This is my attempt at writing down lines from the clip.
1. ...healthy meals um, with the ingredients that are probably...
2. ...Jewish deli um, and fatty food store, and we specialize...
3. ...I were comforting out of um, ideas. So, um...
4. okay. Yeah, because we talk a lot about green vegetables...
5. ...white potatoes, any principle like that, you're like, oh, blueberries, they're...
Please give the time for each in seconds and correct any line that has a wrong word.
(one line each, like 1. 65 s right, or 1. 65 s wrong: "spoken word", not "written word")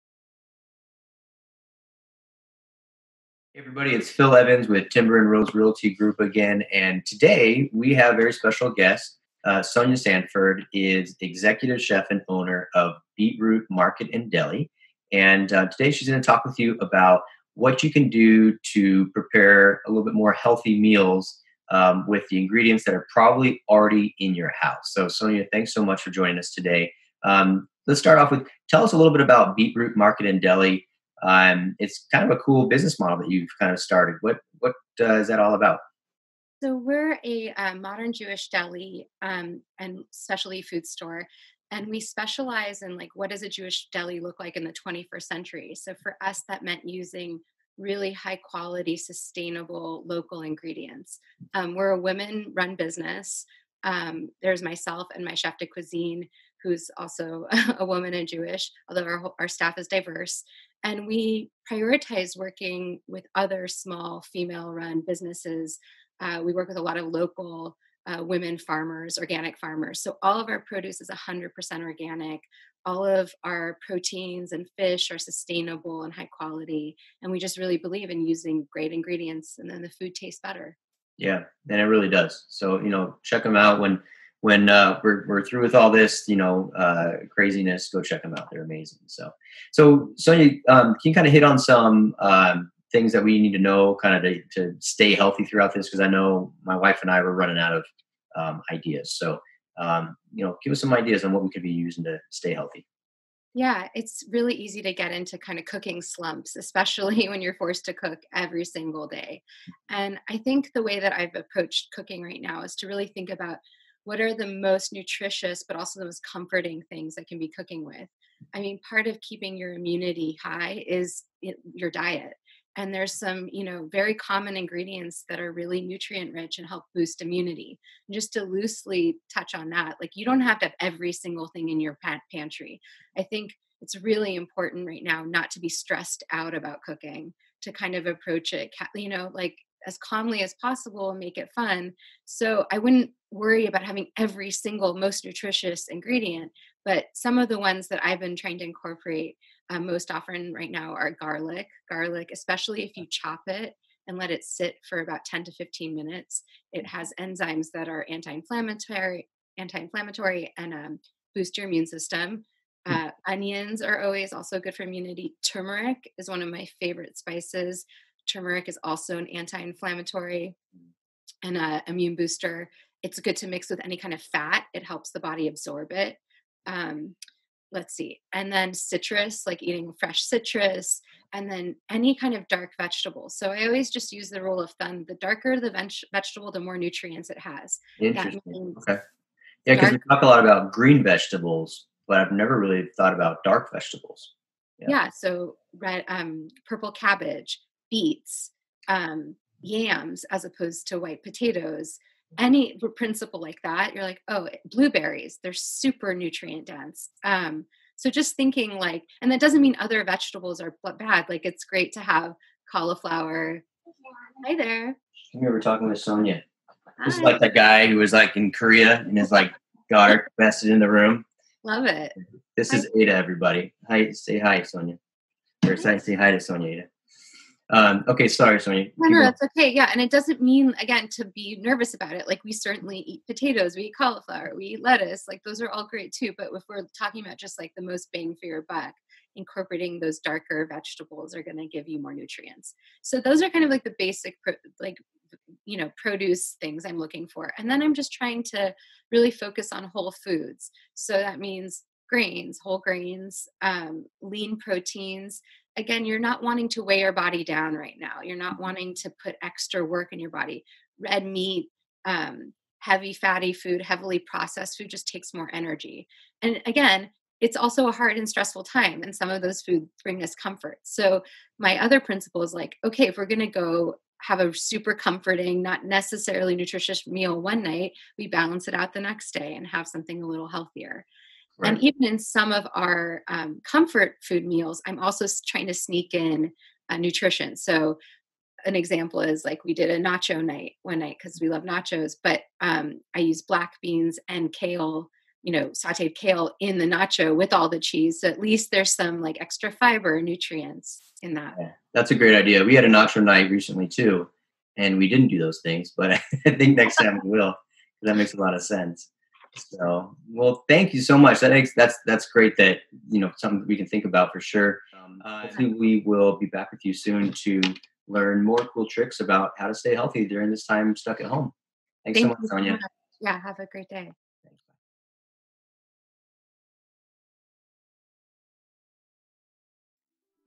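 1. 20 s right
2. 38 s wrong: "specialty", not "fatty"
3. 97 s wrong: "running", not "comforting"
4. 188 s right
5. 200 s right.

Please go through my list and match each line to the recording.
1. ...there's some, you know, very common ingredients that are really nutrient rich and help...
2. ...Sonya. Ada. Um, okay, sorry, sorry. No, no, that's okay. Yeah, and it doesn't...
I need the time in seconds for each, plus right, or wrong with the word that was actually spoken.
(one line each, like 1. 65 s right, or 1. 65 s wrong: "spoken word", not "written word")
1. 122 s right
2. 226 s right.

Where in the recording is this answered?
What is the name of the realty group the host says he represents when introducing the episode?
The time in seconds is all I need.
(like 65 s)
4 s.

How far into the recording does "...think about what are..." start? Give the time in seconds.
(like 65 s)
113 s.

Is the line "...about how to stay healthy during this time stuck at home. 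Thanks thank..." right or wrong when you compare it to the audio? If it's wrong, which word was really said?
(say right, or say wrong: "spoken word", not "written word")
right.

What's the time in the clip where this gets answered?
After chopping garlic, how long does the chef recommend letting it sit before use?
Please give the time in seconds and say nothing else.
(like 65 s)
155 s.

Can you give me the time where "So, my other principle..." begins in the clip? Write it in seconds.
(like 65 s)
270 s.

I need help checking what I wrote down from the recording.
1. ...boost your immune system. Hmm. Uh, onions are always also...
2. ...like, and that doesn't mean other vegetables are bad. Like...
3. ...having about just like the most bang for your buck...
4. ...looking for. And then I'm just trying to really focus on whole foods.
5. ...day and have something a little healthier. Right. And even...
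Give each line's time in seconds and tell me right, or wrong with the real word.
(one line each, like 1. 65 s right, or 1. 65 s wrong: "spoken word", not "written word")
1. 161 s right
2. 208 s right
3. 236 s wrong: "talking", not "having"
4. 246 s right
5. 279 s right.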